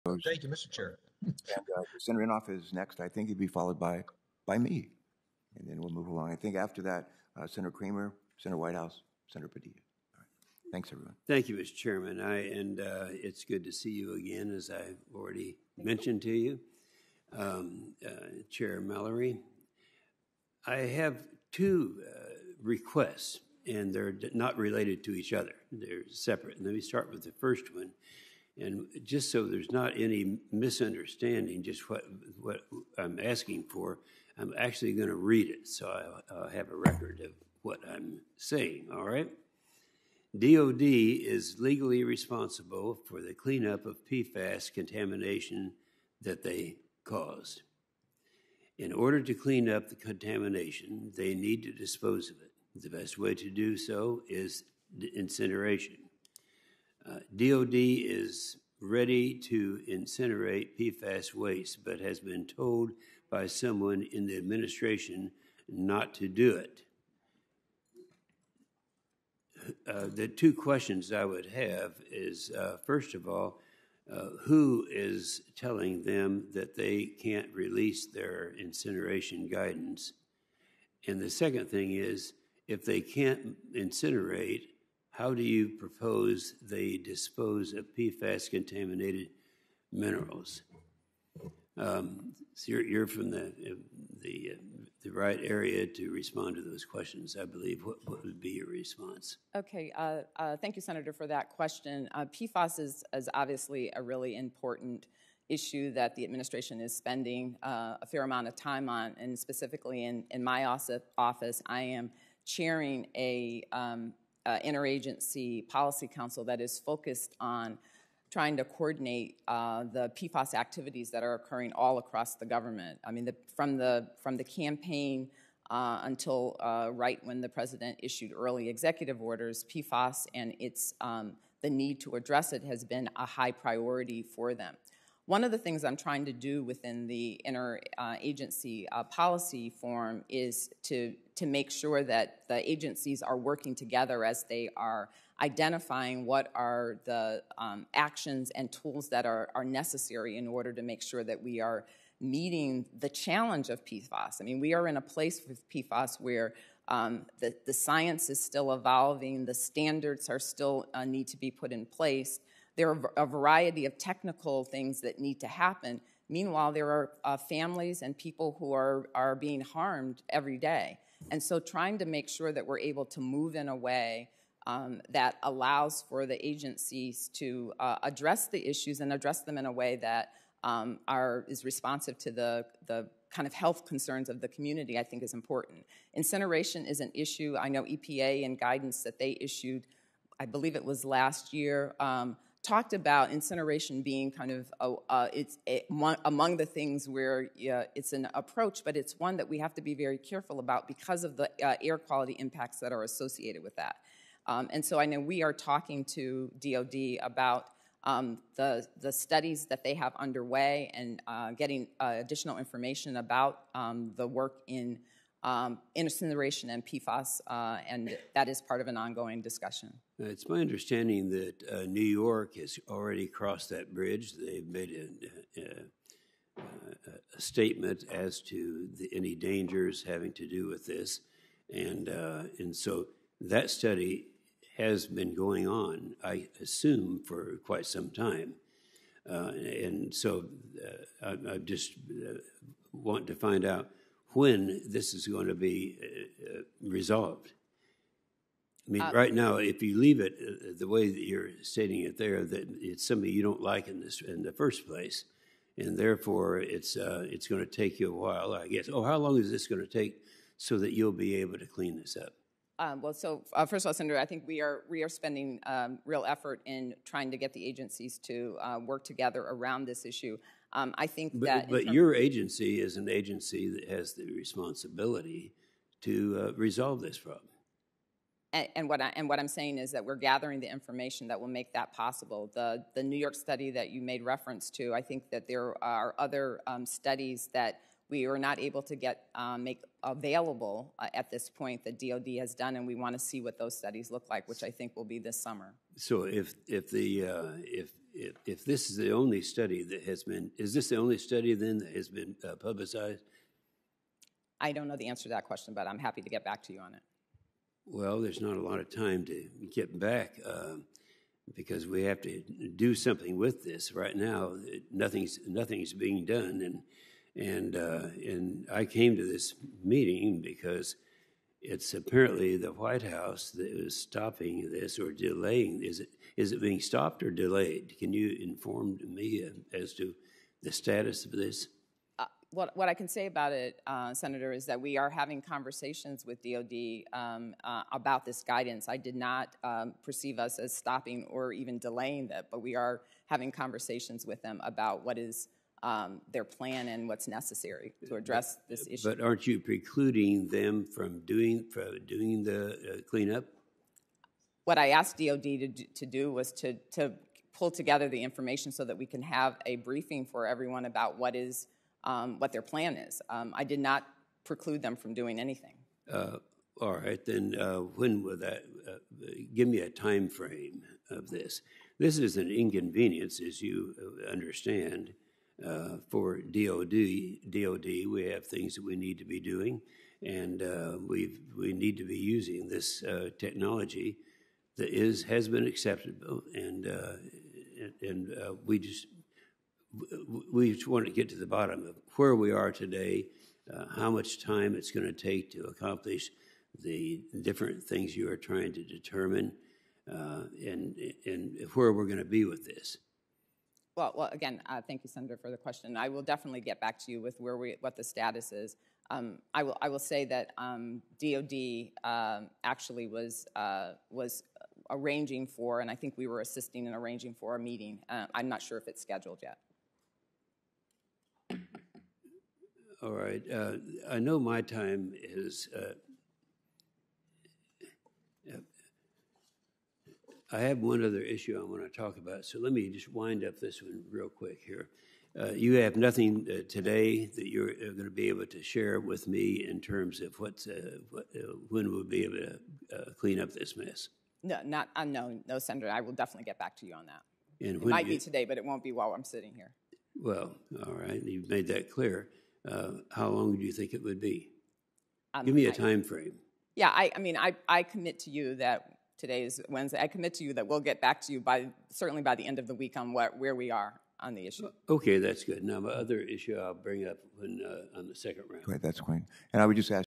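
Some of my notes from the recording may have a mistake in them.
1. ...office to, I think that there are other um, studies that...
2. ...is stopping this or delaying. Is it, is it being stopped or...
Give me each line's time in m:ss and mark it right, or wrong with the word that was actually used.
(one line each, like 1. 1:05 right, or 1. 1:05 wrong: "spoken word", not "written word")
1. 4:44 wrong: "reference", not "office"
2. 5:23 right.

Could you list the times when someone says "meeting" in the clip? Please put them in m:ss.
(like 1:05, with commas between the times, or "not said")
2:32, 5:19, 6:57.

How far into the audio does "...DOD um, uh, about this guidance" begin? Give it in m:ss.
5:36.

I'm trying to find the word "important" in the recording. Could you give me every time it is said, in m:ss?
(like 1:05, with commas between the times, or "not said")
1:44, 3:05.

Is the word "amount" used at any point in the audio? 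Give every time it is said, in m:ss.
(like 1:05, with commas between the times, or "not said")
1:48.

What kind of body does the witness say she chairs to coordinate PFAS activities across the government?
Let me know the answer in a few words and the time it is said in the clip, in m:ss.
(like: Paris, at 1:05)
Interagency policy council, at 1:54.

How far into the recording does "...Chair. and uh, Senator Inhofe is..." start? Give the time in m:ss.
0:00.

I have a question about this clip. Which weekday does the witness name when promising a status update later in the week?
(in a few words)
Wednesday.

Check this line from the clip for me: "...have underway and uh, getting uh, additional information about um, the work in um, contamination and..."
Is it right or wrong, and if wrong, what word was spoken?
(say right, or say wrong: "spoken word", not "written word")
wrong: "incineration", not "contamination".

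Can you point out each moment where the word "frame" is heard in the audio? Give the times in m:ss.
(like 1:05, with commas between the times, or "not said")
6:10, 7:36.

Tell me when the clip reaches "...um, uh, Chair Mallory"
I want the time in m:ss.
0:17.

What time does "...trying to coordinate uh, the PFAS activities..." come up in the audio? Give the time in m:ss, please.
1:58.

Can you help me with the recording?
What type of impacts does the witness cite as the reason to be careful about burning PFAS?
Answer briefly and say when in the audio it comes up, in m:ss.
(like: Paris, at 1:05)
Air quality impacts, at 3:21.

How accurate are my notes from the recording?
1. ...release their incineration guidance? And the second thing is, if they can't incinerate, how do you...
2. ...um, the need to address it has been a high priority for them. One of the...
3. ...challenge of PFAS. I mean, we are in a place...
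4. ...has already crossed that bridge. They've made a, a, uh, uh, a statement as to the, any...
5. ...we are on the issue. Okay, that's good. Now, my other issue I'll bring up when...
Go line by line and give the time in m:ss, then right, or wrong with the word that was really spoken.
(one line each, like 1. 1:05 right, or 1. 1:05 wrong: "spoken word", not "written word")
1. 1:17 right
2. 2:11 right
3. 2:33 right
4. 3:42 right
5. 7:43 right.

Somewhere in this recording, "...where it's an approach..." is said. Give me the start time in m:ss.
3:17.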